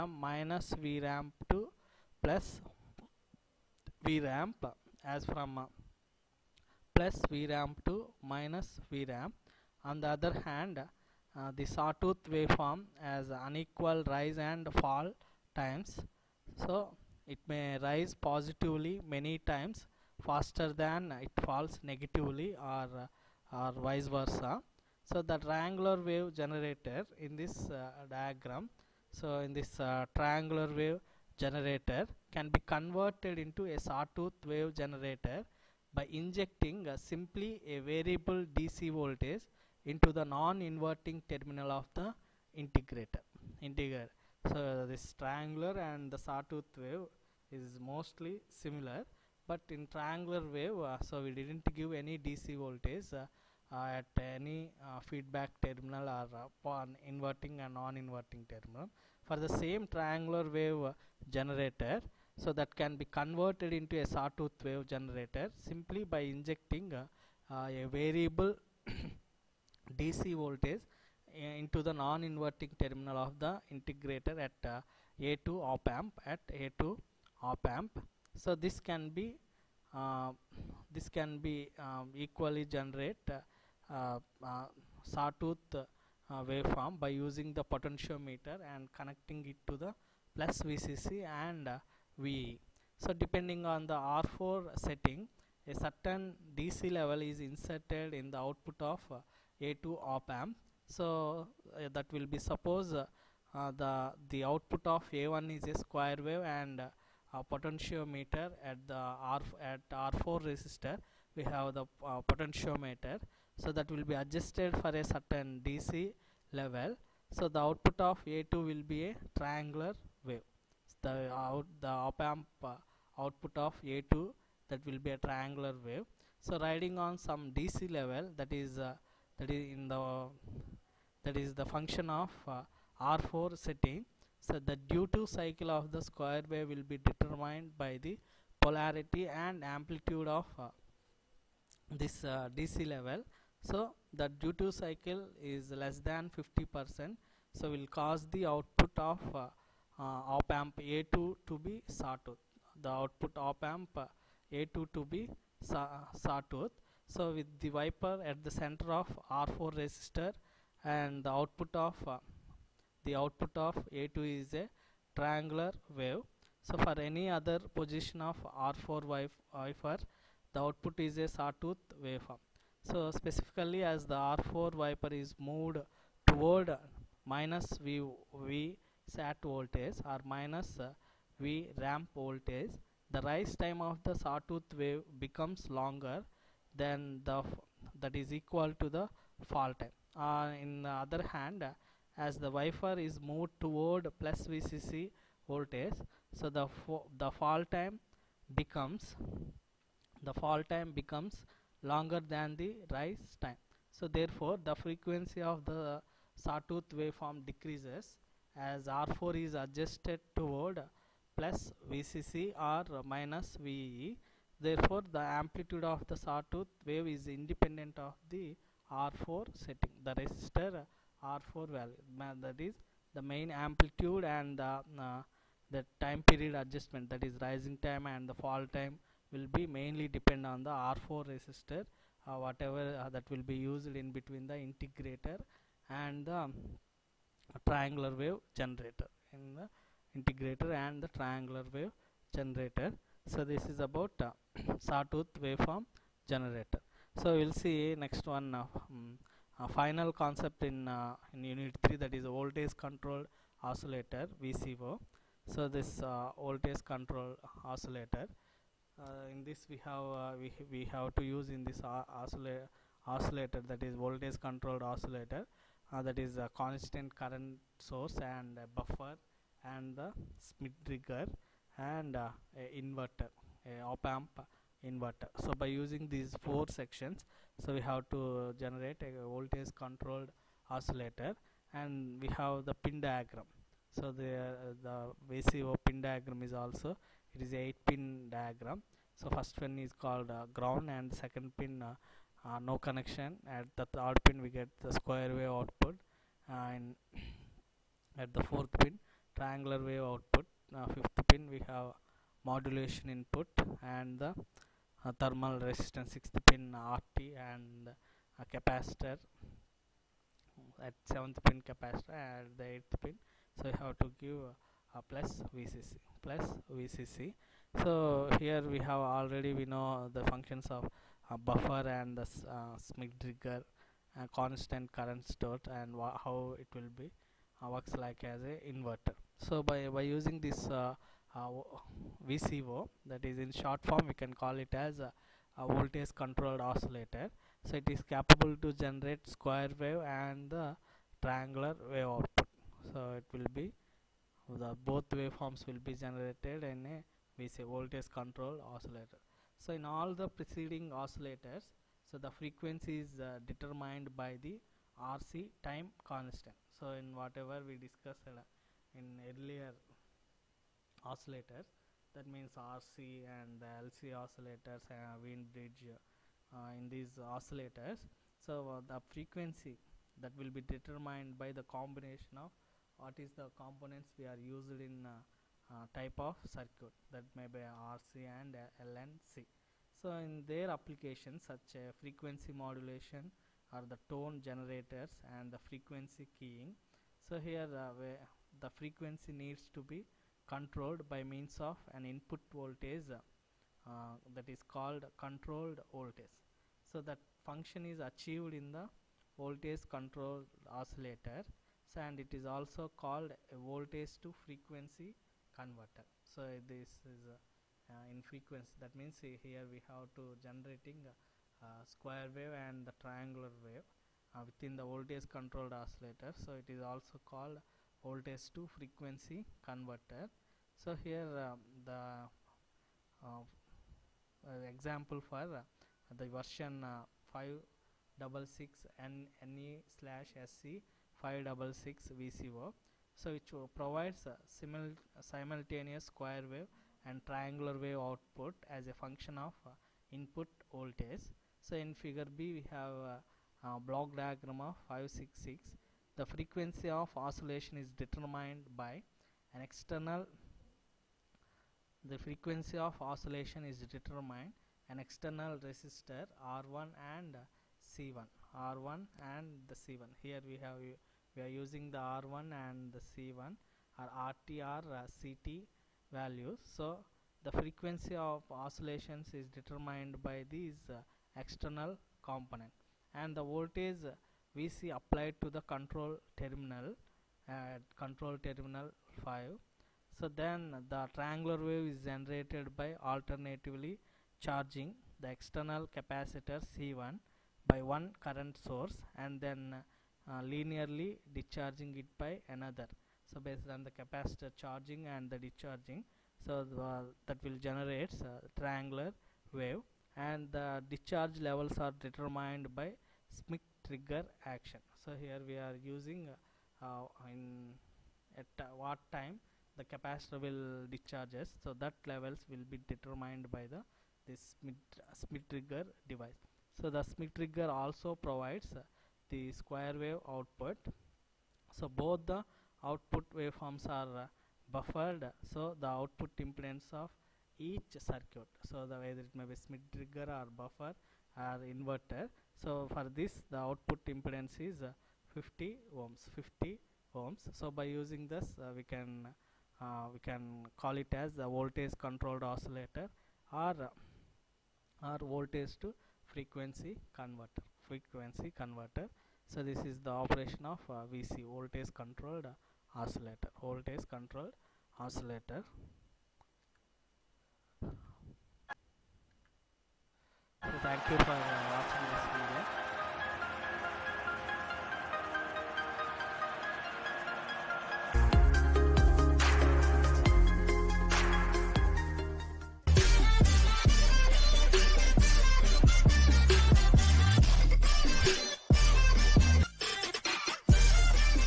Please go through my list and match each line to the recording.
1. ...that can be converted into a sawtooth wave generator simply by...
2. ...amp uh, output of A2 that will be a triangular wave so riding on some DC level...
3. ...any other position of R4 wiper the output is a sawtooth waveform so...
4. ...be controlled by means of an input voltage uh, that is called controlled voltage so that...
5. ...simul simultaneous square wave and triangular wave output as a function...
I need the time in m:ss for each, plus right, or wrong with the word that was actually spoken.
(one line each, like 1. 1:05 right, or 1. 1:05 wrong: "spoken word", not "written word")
1. 1:02 right
2. 2:02 right
3. 2:46 right
4. 6:29 right
5. 7:14 right.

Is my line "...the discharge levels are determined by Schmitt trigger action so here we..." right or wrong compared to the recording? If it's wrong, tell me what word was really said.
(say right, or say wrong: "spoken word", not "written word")
right.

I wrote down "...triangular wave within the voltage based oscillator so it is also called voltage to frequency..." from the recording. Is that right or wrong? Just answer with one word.
wrong.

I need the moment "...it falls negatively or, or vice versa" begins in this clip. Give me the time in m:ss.
0:21.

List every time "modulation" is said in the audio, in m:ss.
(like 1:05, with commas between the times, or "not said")
5:02, 6:22.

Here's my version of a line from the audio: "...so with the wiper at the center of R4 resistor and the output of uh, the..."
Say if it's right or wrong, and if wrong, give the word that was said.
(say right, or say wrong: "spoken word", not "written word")
right.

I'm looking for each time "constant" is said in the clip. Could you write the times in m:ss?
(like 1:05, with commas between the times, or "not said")
4:26, 5:24, 5:56.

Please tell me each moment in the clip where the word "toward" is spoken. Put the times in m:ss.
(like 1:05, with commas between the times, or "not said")
2:56, 3:13, 3:30.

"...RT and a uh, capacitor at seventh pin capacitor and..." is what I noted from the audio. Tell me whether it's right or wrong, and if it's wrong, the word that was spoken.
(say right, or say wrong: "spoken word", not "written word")
right.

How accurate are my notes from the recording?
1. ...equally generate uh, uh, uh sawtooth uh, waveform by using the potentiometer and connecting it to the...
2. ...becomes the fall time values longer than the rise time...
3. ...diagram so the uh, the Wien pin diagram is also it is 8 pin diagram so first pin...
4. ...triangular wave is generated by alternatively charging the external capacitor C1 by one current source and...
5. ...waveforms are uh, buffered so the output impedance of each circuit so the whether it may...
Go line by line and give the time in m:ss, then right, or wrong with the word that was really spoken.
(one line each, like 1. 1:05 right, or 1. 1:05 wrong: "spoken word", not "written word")
1. 1:22 right
2. 3:18 wrong: "becomes", not "values"
3. 4:43 wrong: "VCO", not "Wien"
4. 8:01 right
5. 8:43 right.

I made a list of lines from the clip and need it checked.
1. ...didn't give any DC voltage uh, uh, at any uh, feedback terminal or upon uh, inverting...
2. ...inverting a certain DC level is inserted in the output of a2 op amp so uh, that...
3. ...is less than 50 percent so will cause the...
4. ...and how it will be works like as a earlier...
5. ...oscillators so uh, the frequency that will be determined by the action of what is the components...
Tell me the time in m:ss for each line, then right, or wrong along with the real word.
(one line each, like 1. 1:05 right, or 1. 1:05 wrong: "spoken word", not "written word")
1. 0:51 right
2. 1:34 wrong: "setting", not "inverting"
3. 2:25 right
4. 5:25 wrong: "inverter", not "earlier"
5. 6:07 wrong: "combination", not "action".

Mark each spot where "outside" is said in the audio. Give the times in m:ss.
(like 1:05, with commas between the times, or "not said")
not said.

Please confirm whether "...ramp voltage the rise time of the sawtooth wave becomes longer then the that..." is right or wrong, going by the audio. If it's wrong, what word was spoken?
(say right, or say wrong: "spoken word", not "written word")
right.